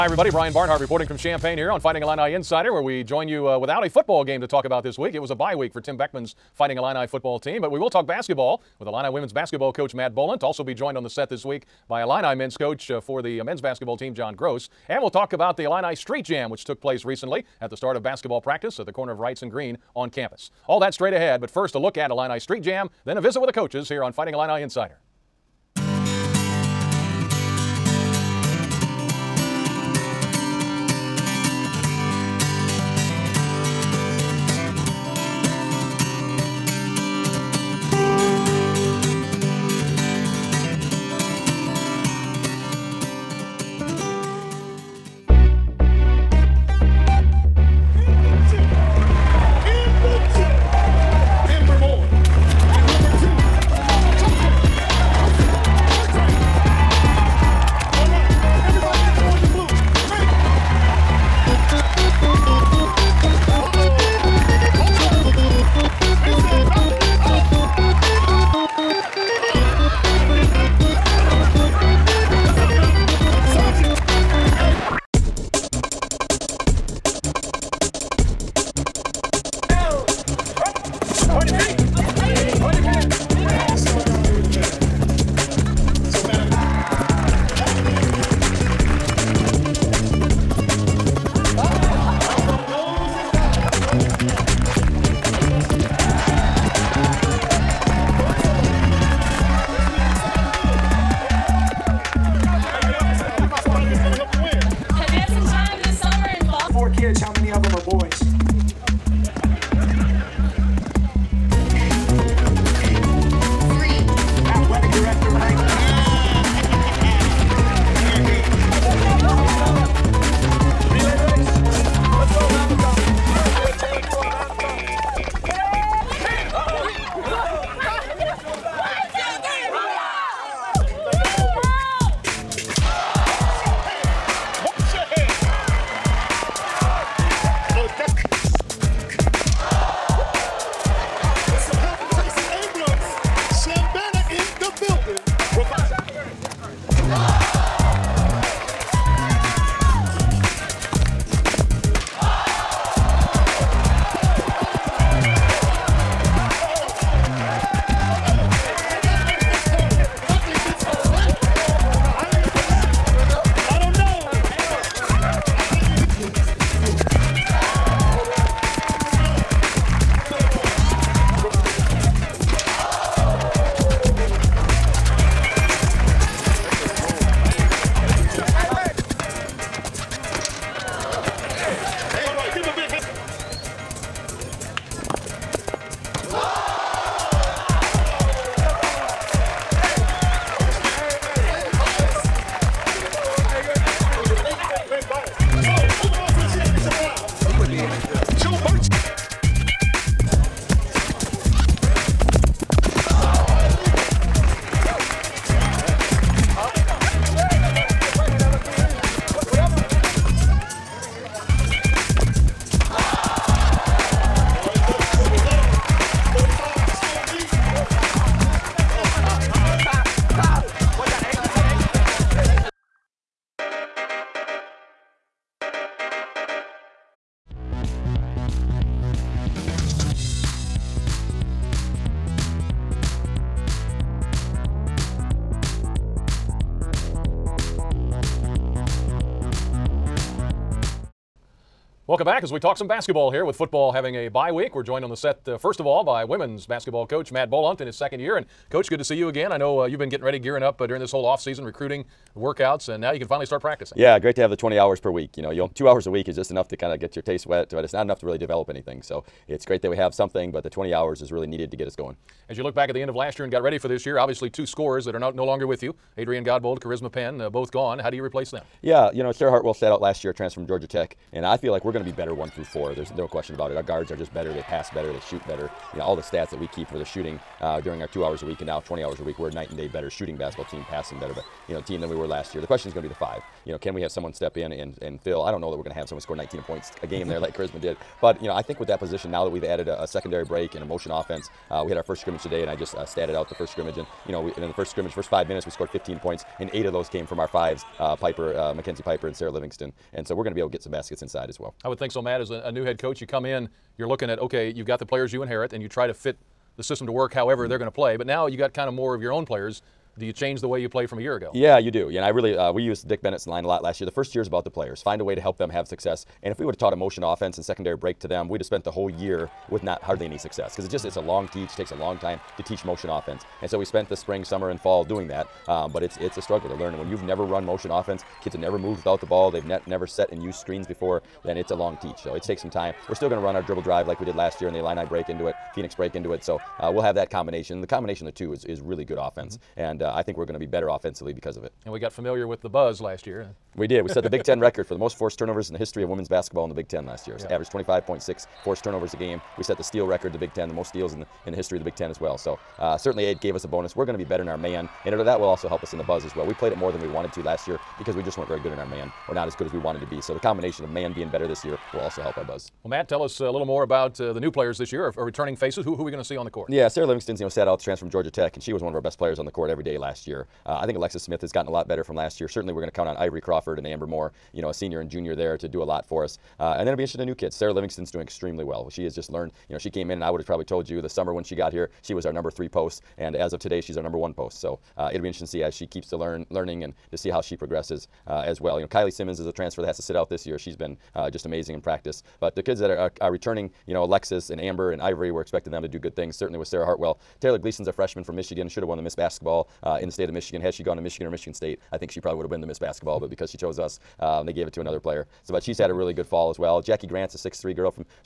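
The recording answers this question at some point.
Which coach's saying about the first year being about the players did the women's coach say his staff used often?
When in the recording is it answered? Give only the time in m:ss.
5:13.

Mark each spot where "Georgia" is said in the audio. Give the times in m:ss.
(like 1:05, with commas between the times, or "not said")
4:30, 6:08.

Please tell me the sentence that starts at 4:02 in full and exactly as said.
Welcome back as we talk some basketball here with football having a bye week.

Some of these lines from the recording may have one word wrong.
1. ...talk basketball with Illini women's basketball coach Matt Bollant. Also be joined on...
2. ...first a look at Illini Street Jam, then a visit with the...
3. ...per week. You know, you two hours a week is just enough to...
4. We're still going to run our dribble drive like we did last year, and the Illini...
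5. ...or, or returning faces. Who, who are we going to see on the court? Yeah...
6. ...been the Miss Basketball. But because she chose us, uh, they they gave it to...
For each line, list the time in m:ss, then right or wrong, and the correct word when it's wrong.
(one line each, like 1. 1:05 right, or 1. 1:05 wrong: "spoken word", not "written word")
1. 0:07 right
2. 0:21 right
3. 4:14 right
4. 5:33 right
5. 6:05 right
6. 6:42 right.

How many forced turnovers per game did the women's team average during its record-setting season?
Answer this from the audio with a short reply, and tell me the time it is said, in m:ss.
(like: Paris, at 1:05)
25.6, at 5:47.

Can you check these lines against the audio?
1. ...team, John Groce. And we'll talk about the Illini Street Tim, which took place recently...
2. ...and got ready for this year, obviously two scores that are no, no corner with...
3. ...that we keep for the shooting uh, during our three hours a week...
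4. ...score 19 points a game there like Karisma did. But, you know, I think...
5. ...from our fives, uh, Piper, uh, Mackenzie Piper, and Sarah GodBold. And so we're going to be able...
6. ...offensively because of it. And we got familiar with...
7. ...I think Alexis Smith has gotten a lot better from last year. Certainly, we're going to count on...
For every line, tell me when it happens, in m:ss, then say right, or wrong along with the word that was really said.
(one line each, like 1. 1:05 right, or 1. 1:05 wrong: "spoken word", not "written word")
1. 0:13 wrong: "Jam", not "Tim"
2. 4:23 wrong: "longer", not "corner"
3. 4:36 wrong: "two", not "three"
4. 4:46 right
5. 4:57 wrong: "Livingston", not "GodBold"
6. 5:40 right
7. 6:10 right.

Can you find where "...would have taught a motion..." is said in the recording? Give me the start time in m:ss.
5:16.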